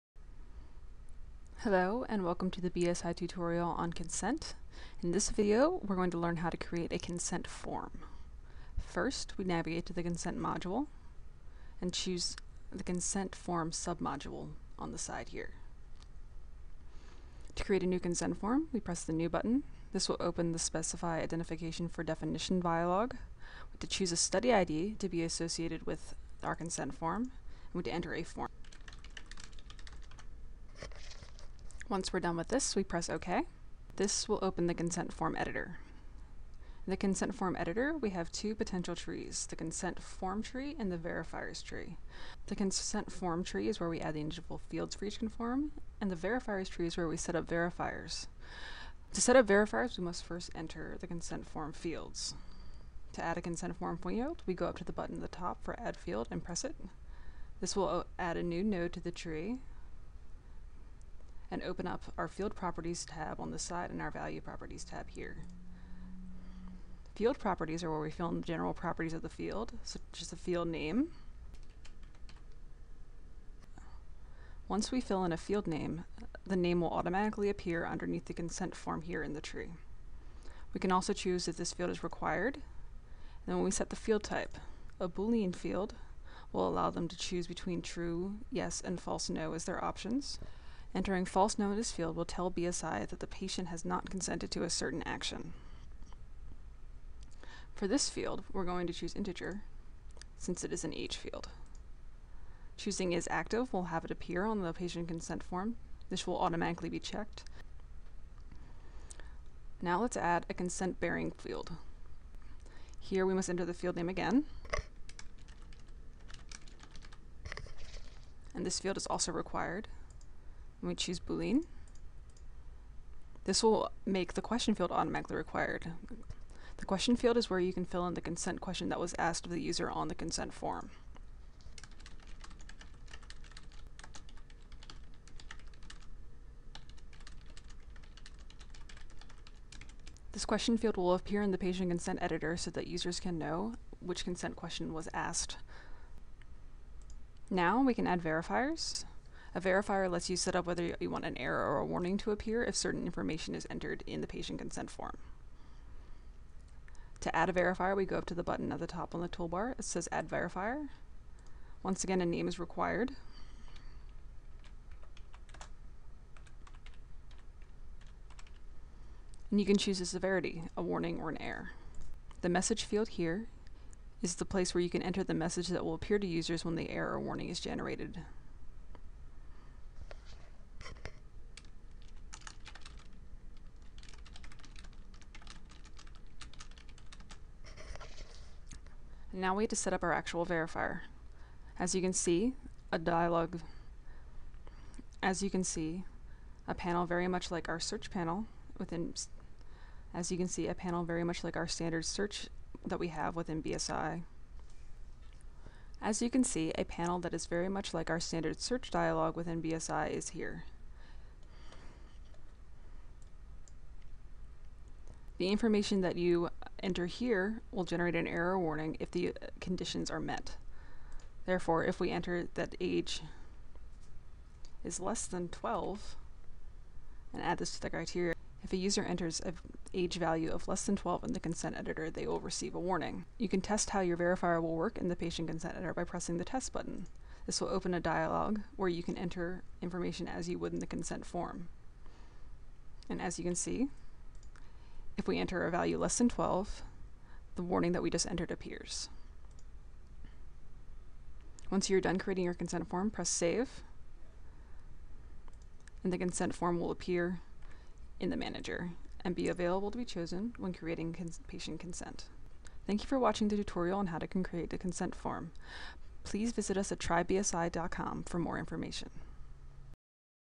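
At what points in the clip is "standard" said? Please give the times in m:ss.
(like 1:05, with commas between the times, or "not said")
3:21, 3:28.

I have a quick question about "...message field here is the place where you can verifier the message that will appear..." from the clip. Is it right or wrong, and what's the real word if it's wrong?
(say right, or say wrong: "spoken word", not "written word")
wrong: "enter", not "verifier".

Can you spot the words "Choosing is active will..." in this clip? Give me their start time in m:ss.
1:42.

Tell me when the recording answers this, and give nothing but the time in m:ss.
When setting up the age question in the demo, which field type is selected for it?
1:39.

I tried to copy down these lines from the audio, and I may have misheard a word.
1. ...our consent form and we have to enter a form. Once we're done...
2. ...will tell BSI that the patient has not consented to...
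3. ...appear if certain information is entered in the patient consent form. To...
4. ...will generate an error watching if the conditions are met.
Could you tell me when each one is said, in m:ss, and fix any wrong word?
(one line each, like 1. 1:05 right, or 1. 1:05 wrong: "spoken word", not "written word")
1. 0:26 right
2. 1:32 right
3. 2:32 right
4. 3:37 wrong: "warning", not "watching".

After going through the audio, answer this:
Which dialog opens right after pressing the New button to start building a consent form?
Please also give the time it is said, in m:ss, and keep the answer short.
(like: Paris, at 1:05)
Specify identification for definition, at 0:20.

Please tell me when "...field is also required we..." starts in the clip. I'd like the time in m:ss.
1:58.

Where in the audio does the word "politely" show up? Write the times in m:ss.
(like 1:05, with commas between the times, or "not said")
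not said.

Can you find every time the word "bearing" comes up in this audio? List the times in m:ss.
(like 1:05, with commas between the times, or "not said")
1:50.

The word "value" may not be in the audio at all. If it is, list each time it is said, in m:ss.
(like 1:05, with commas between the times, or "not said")
1:04, 3:50, 4:05.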